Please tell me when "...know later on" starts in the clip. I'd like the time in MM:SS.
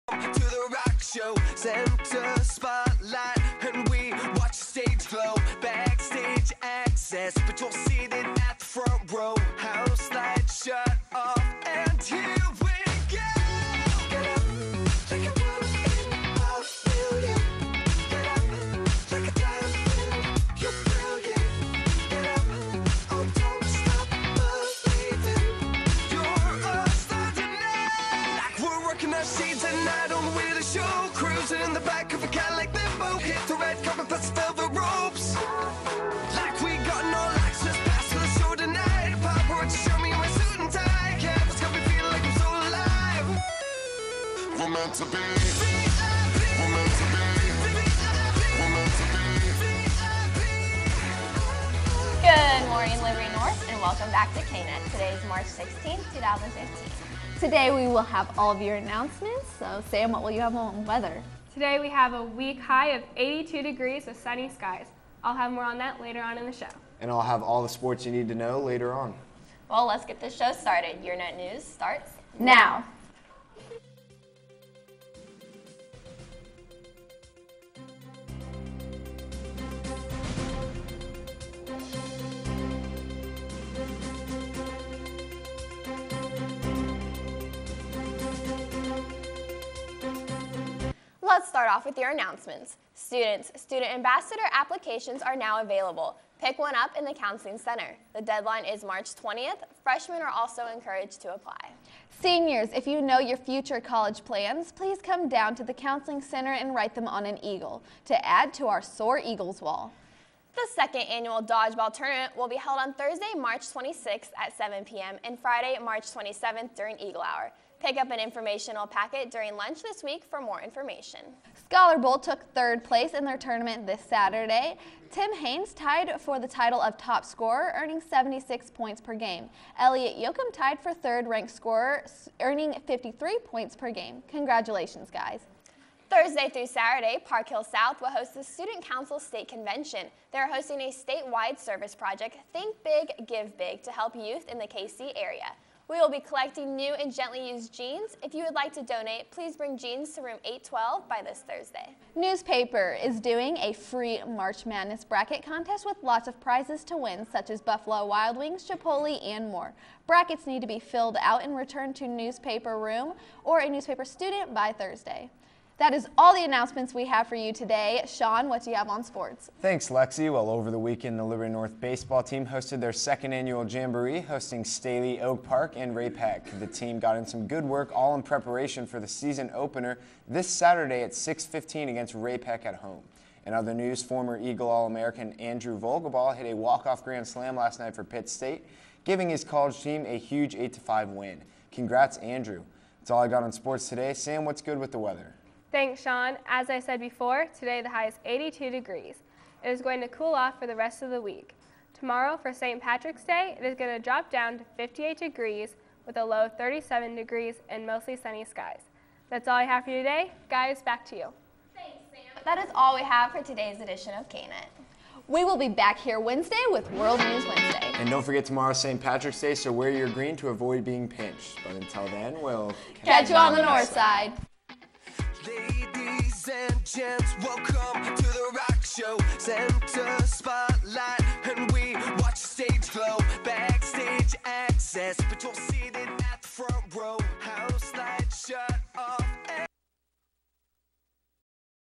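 01:08.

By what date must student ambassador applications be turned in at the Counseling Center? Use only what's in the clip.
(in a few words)
March 20th.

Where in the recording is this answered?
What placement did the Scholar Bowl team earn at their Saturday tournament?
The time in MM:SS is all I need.
02:02.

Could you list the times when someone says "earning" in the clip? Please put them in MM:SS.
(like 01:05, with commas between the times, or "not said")
02:07, 02:12.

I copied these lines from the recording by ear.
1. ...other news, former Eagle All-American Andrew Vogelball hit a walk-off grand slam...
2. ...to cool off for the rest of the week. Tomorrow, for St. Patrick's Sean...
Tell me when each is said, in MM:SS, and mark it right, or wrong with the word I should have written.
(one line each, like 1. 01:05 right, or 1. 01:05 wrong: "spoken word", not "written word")
1. 03:03 right
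2. 03:20 wrong: "Day", not "Sean".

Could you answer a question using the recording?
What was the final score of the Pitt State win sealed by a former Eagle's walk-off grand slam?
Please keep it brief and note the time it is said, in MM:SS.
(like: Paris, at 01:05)
8-5, at 03:10.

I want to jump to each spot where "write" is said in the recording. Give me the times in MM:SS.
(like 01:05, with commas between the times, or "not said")
01:46.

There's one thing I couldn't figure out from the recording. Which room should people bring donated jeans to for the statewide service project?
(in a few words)
room 812.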